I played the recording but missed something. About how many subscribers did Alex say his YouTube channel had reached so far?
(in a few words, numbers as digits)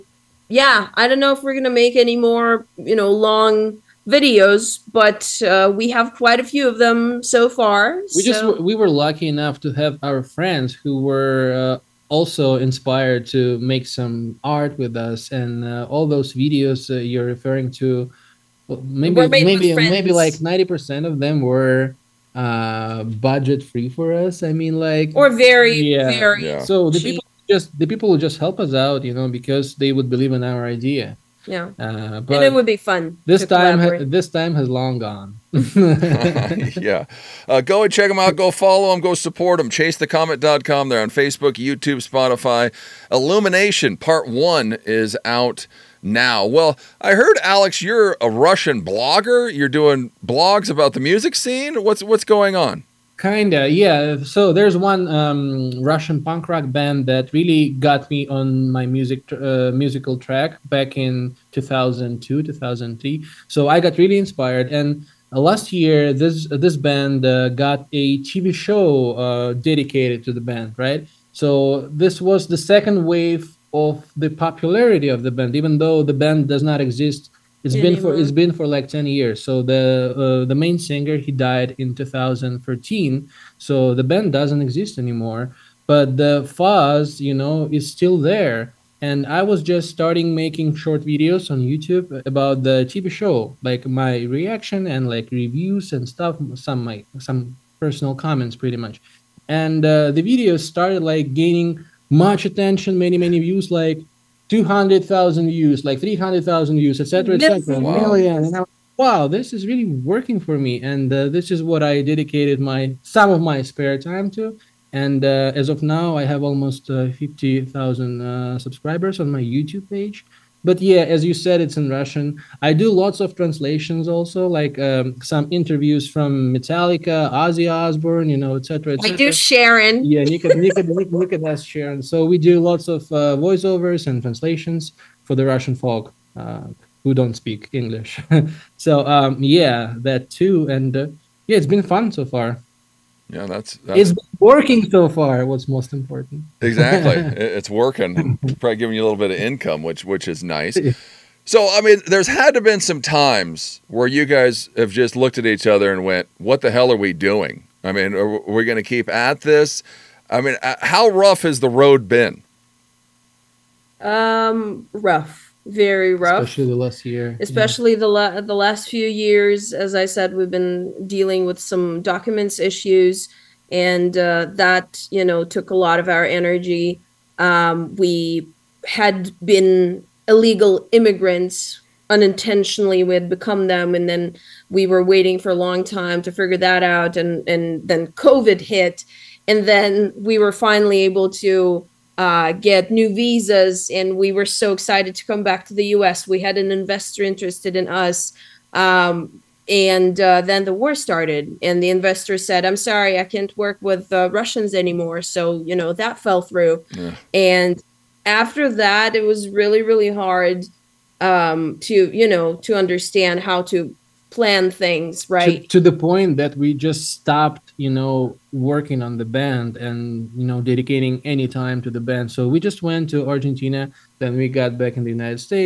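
50,000.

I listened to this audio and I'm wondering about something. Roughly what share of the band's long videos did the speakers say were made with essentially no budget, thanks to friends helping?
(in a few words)
90 percent.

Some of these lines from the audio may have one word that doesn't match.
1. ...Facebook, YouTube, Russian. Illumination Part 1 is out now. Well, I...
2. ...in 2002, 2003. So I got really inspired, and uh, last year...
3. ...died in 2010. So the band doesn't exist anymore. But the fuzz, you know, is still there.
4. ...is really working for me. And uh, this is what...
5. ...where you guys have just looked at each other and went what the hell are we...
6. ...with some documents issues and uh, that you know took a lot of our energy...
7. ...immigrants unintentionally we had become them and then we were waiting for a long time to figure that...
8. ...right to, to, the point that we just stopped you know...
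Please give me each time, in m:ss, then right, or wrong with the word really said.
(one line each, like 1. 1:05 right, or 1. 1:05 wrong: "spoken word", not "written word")
1. 0:41 wrong: "Spotify", not "Russian"
2. 1:00 right
3. 1:21 wrong: "2013", not "2010"
4. 1:49 right
5. 2:33 right
6. 2:51 right
7. 3:00 right
8. 3:35 right.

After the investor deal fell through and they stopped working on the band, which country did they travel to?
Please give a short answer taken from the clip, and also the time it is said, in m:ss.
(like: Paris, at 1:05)
Argentina, at 3:43.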